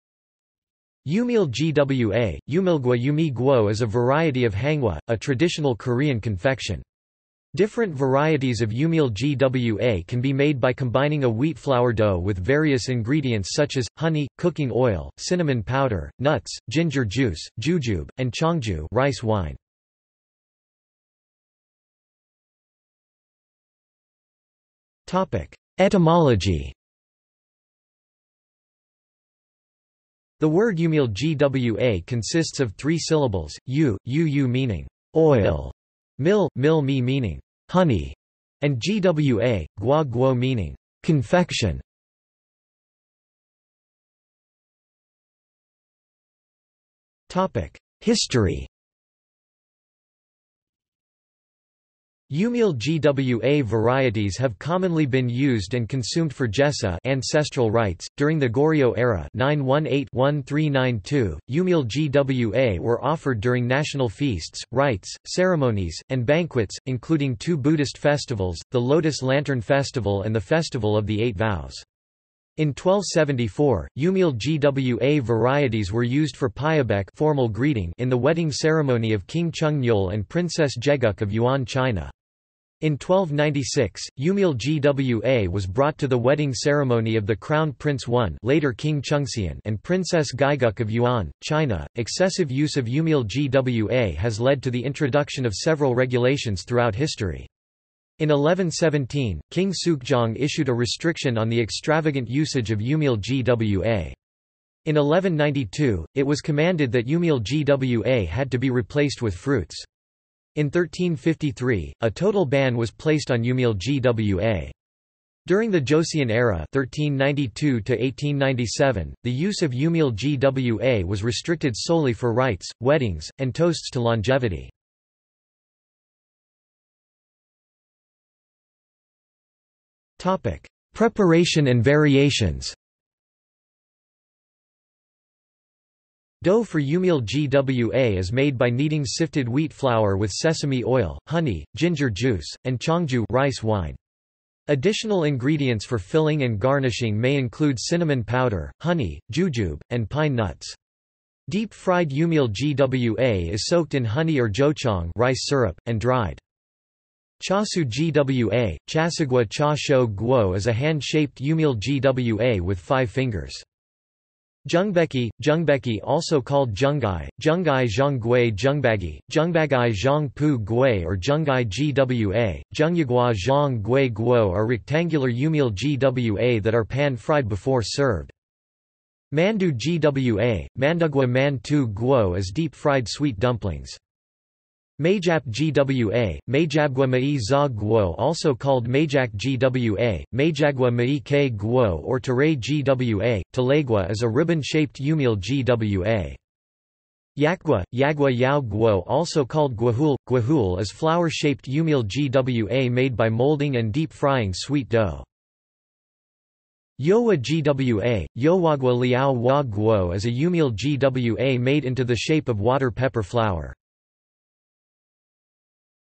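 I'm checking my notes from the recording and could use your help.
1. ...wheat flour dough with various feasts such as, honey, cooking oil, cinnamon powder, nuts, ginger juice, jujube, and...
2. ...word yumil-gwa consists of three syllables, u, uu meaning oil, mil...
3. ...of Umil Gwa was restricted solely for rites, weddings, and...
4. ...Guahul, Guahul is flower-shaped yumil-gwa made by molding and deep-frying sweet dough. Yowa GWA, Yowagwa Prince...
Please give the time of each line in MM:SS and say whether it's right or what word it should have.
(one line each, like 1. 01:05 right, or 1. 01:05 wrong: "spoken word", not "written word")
1. 00:11 wrong: "ingredients", not "feasts"
2. 00:30 right
3. 01:59 right
4. 03:19 wrong: "Liao", not "Prince".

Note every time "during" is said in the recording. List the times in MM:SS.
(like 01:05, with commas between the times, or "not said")
00:58, 01:03, 01:55.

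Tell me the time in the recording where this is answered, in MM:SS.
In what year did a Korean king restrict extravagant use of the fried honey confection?
01:38.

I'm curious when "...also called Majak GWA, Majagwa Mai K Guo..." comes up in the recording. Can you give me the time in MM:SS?
03:08.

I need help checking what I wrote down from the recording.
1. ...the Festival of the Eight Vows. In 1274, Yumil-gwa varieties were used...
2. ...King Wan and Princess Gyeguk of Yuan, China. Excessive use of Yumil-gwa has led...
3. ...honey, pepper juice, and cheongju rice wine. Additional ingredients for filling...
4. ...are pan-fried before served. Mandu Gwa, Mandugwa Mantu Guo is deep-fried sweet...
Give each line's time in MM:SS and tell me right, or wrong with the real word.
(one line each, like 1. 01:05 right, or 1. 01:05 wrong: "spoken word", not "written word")
1. 01:10 right
2. 01:28 wrong: "Chungseon", not "Wan"
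3. 02:21 wrong: "ginger", not "pepper"
4. 02:56 right.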